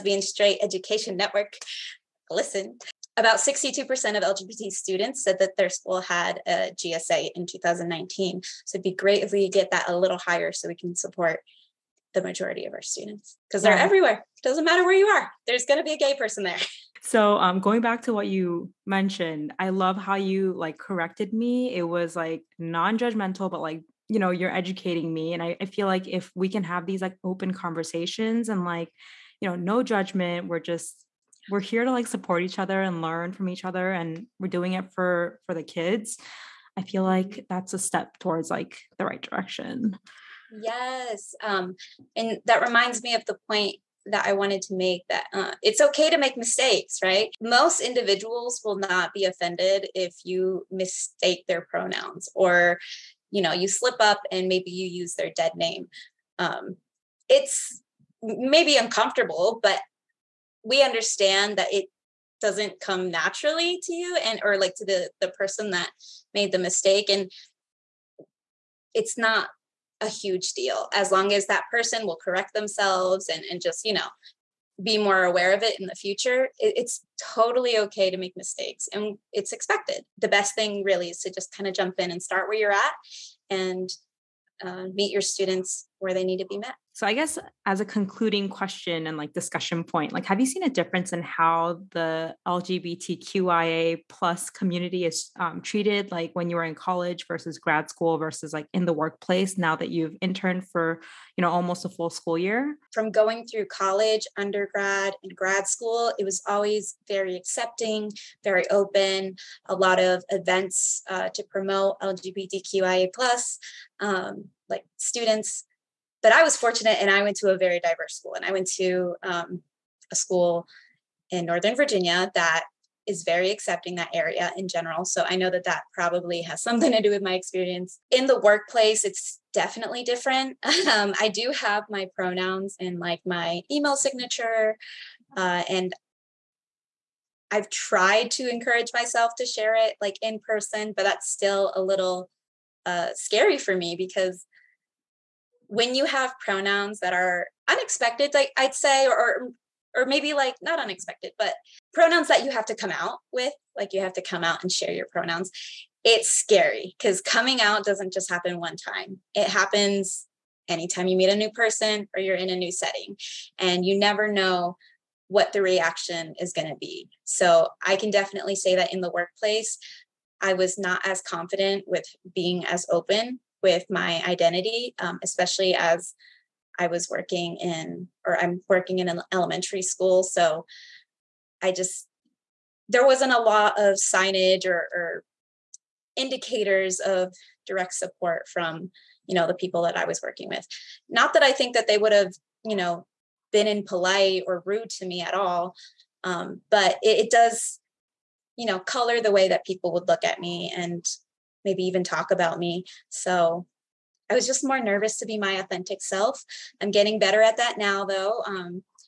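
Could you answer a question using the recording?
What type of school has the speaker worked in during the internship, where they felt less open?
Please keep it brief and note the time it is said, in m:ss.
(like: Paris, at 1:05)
Elementary school, at 2:59.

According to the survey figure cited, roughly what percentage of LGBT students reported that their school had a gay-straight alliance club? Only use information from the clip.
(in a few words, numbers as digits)
62%.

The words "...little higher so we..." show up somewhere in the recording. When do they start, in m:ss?
0:09.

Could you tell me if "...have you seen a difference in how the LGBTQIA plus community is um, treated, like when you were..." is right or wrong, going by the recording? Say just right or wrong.
right.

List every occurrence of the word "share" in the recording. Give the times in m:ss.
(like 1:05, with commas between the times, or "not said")
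2:19, 2:34.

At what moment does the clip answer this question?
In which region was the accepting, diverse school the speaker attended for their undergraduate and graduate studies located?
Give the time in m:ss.
2:01.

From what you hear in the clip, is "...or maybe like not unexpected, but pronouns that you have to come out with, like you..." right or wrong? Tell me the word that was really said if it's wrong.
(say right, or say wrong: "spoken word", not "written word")
right.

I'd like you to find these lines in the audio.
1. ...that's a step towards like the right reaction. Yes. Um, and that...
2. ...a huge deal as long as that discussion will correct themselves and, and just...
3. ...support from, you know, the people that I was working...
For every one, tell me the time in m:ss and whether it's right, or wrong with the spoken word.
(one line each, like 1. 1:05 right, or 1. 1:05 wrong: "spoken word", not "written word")
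1. 0:37 wrong: "direction", not "reaction"
2. 1:10 wrong: "person", not "discussion"
3. 3:07 right.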